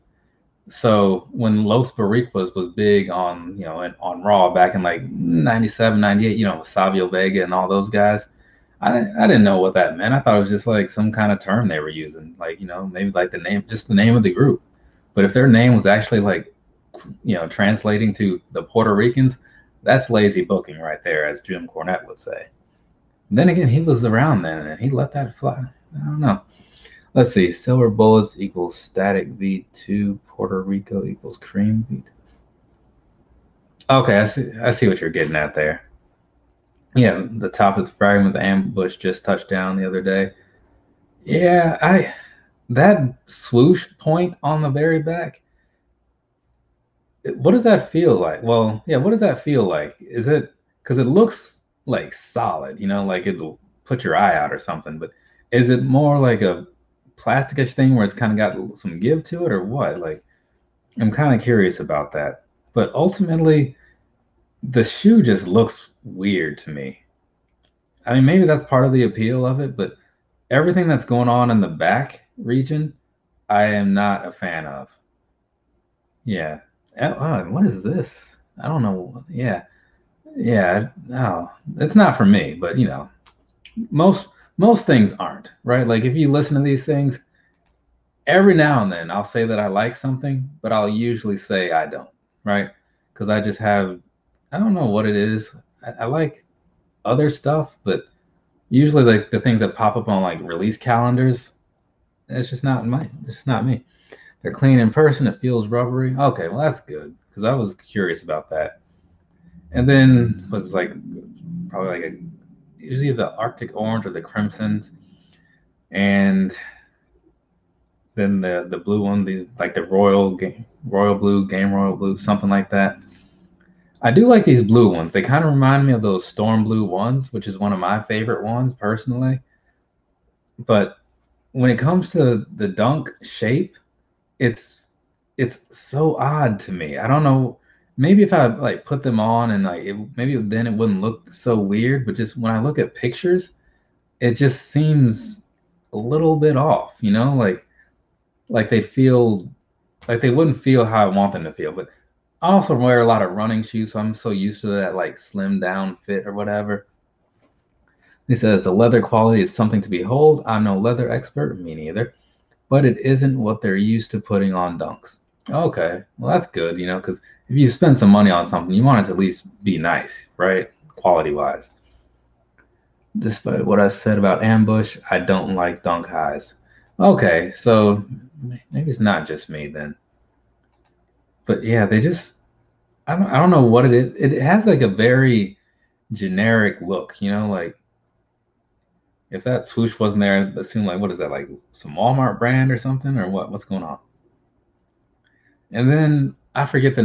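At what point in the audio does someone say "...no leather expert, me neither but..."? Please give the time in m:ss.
2:40.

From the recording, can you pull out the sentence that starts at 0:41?
Yeah, I that swoosh point on the very back what does that feel like?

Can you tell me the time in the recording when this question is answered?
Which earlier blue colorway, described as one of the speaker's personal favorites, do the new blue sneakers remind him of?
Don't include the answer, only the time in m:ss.
2:06.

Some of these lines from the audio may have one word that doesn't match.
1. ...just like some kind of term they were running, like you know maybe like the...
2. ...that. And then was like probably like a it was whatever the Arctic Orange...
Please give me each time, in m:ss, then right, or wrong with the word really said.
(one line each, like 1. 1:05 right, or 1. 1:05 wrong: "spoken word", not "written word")
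1. 0:10 wrong: "using", not "running"
2. 1:48 wrong: "either", not "whatever".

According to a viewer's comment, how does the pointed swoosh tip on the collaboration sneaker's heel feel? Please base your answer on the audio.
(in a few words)
Rubbery.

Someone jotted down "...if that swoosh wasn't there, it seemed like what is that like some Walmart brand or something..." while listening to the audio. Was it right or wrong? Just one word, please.
right.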